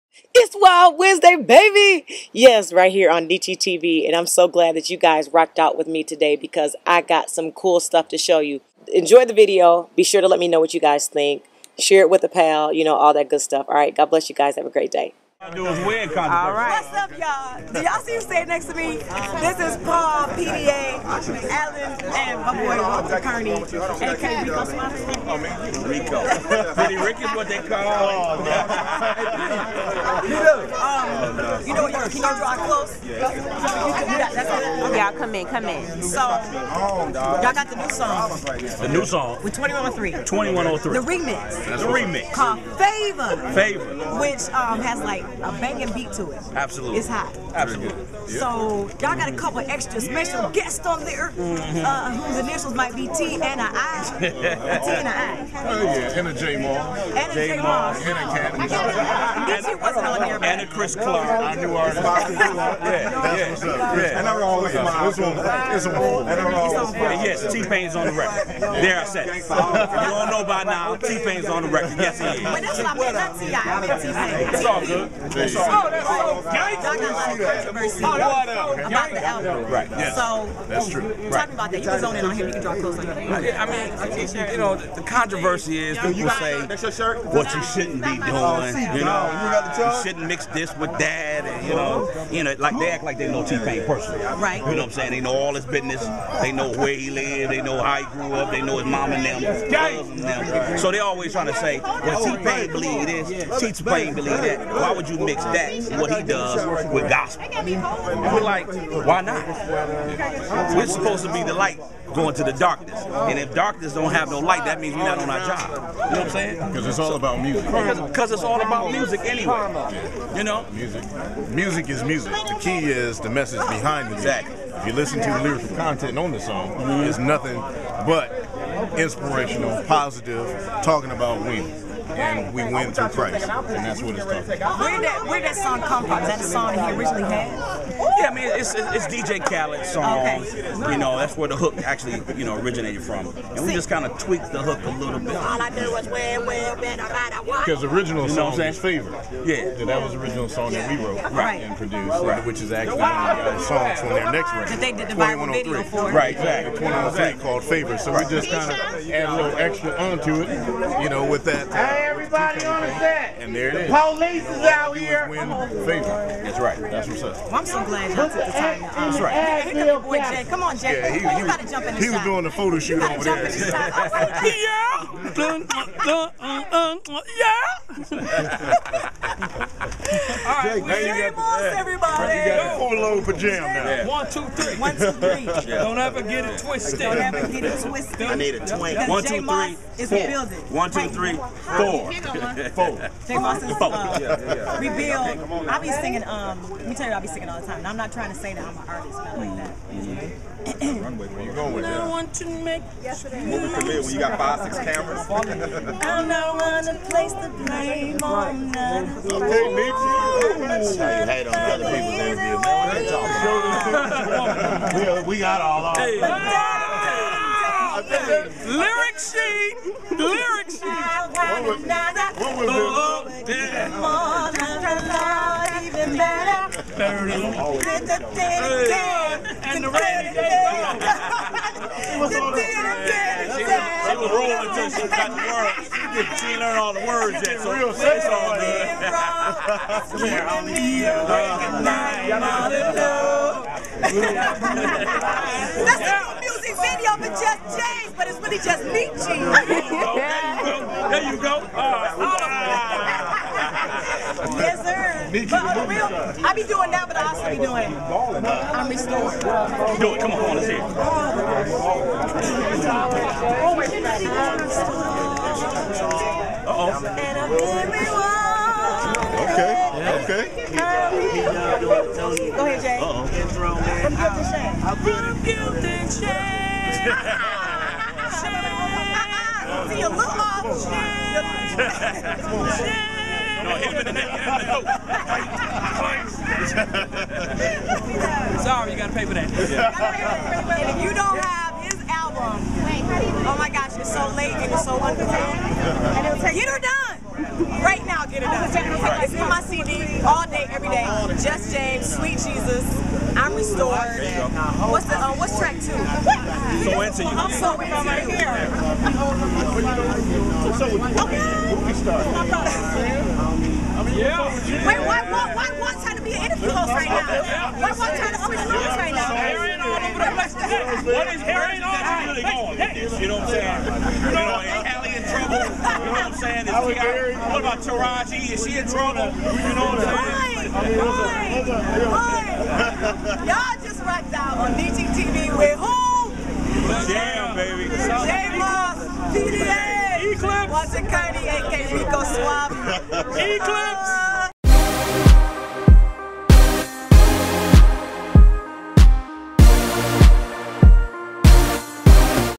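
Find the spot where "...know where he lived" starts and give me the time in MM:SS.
01:36.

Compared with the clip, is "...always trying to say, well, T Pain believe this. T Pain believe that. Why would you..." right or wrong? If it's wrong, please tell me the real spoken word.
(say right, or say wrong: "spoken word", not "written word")
right.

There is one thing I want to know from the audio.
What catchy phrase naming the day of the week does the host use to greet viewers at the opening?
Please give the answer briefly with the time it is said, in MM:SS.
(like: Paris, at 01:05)
Wild Wednesday, at 00:00.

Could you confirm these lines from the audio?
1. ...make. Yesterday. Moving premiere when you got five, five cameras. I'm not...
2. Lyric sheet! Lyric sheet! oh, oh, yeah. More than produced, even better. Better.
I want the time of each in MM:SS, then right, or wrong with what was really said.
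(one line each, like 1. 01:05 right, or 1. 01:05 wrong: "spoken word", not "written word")
1. 03:22 wrong: "six", not "five"
2. 03:38 wrong: "allowed", not "produced".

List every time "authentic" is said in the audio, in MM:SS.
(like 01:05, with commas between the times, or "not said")
not said.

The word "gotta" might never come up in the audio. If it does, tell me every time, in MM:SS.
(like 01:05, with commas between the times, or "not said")
02:51, 04:48.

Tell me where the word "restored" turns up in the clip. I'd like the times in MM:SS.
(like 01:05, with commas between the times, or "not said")
04:18, 05:03.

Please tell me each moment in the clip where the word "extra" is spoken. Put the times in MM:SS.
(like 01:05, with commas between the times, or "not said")
00:49, 02:39.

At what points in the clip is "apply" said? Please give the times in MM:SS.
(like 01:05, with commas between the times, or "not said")
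not said.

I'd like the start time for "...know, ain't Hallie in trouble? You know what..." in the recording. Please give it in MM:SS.
05:24.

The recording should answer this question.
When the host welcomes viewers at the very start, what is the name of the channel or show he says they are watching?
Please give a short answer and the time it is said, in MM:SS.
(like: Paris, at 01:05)
Neechy TV, at 00:03.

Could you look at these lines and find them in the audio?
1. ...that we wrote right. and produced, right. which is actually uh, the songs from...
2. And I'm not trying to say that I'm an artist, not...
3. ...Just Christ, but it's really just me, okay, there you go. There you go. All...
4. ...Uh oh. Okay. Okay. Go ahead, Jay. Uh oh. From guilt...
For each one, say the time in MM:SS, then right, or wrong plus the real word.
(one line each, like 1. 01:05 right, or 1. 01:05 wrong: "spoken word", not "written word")
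1. 02:30 right
2. 03:17 right
3. 04:07 wrong: "James", not "Christ"
4. 04:26 right.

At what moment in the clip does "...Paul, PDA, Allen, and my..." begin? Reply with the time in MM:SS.
00:19.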